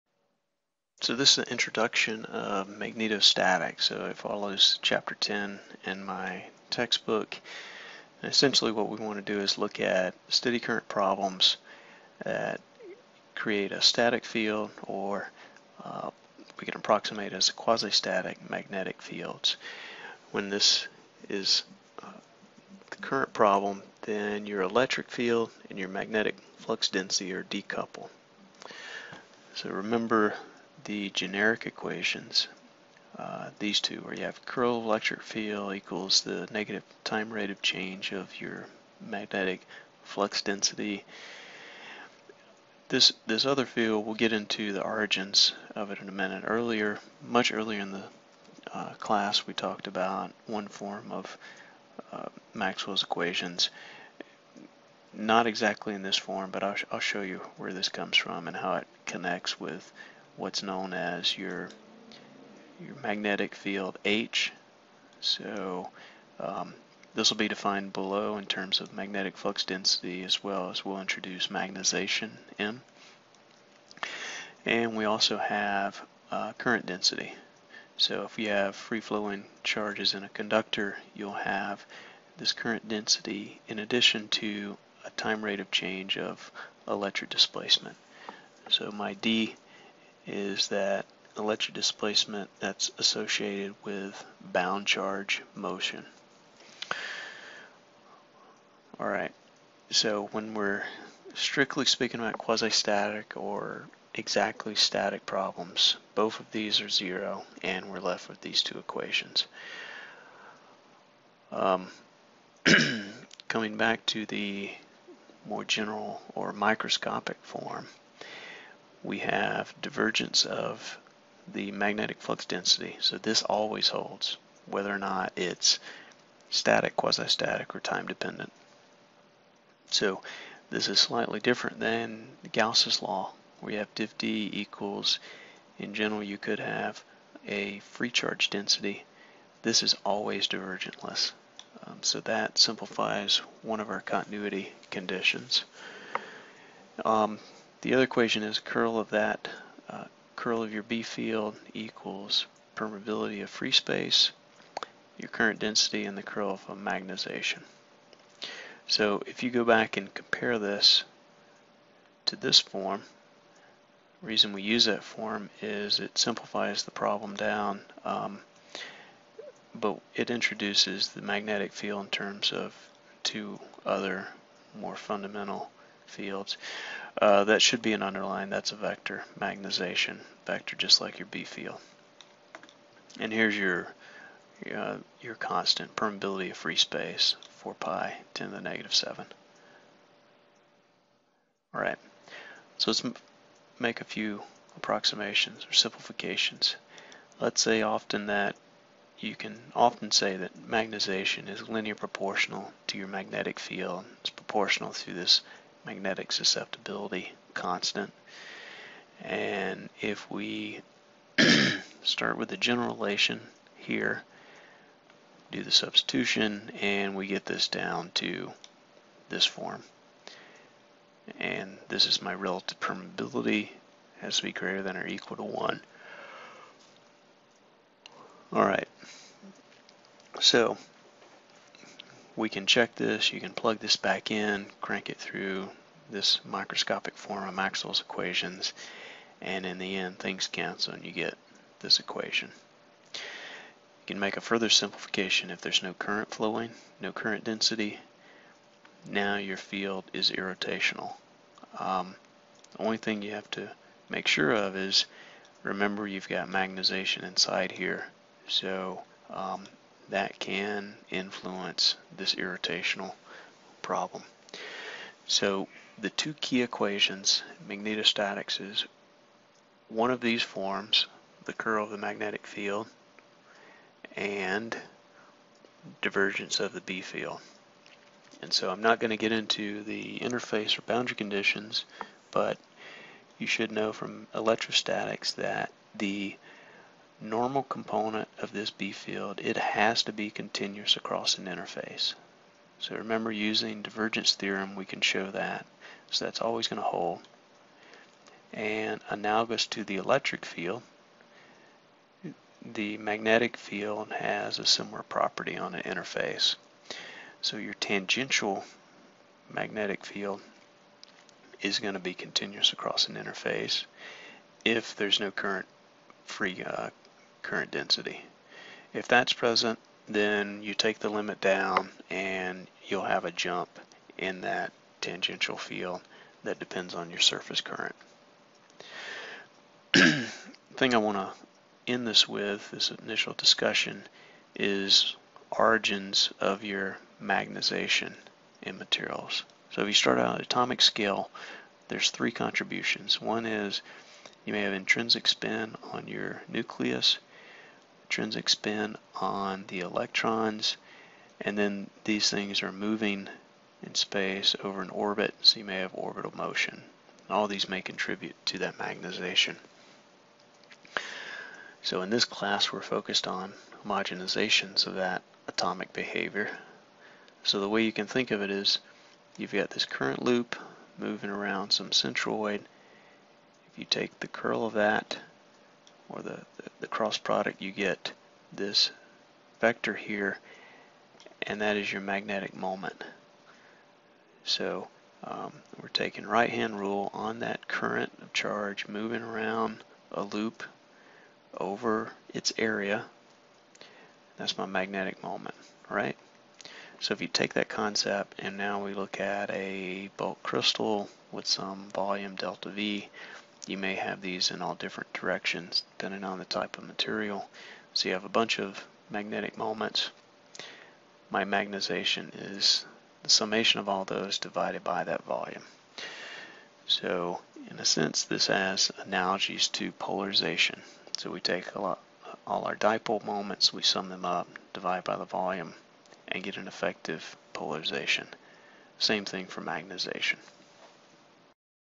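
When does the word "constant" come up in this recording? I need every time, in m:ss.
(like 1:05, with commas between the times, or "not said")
3:05, 3:27.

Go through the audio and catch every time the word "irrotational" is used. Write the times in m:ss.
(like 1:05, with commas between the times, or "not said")
4:10, 4:22.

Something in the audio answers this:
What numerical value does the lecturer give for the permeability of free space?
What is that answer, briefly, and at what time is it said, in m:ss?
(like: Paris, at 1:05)
4 pi × 10^-7, at 3:07.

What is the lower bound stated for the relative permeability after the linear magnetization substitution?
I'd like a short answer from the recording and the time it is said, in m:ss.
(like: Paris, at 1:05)
1, at 3:44.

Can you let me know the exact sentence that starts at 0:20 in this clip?
When this is uh, the current problem, then your electric field and your magnetic flux density are decoupled.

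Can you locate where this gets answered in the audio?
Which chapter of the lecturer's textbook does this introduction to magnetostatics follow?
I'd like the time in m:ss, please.
0:04.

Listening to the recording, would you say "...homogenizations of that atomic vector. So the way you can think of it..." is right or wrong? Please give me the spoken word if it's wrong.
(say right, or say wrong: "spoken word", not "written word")
wrong: "behavior", not "vector".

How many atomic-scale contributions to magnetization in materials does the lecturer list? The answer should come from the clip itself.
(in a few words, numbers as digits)
3.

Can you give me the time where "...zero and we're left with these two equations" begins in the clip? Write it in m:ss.
1:46.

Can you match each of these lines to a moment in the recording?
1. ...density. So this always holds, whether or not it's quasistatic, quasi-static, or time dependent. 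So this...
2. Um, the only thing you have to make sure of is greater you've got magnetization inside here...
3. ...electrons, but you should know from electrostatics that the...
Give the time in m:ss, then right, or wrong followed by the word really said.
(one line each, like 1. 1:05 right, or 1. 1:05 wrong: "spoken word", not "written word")
1. 2:02 wrong: "static", not "quasistatic"
2. 4:11 wrong: "remember", not "greater"
3. 4:41 wrong: "conditions", not "electrons".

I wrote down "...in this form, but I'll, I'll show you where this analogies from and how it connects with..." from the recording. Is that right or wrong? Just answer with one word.
wrong.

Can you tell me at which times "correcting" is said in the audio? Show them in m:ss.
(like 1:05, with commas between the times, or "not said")
not said.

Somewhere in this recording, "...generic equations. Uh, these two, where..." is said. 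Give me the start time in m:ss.
0:31.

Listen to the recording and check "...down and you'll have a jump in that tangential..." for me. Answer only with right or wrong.
right.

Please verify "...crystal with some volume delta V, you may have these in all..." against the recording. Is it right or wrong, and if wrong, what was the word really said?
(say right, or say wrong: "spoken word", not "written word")
right.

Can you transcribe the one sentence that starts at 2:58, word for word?
That's a vector magnetization vector, just like your B field.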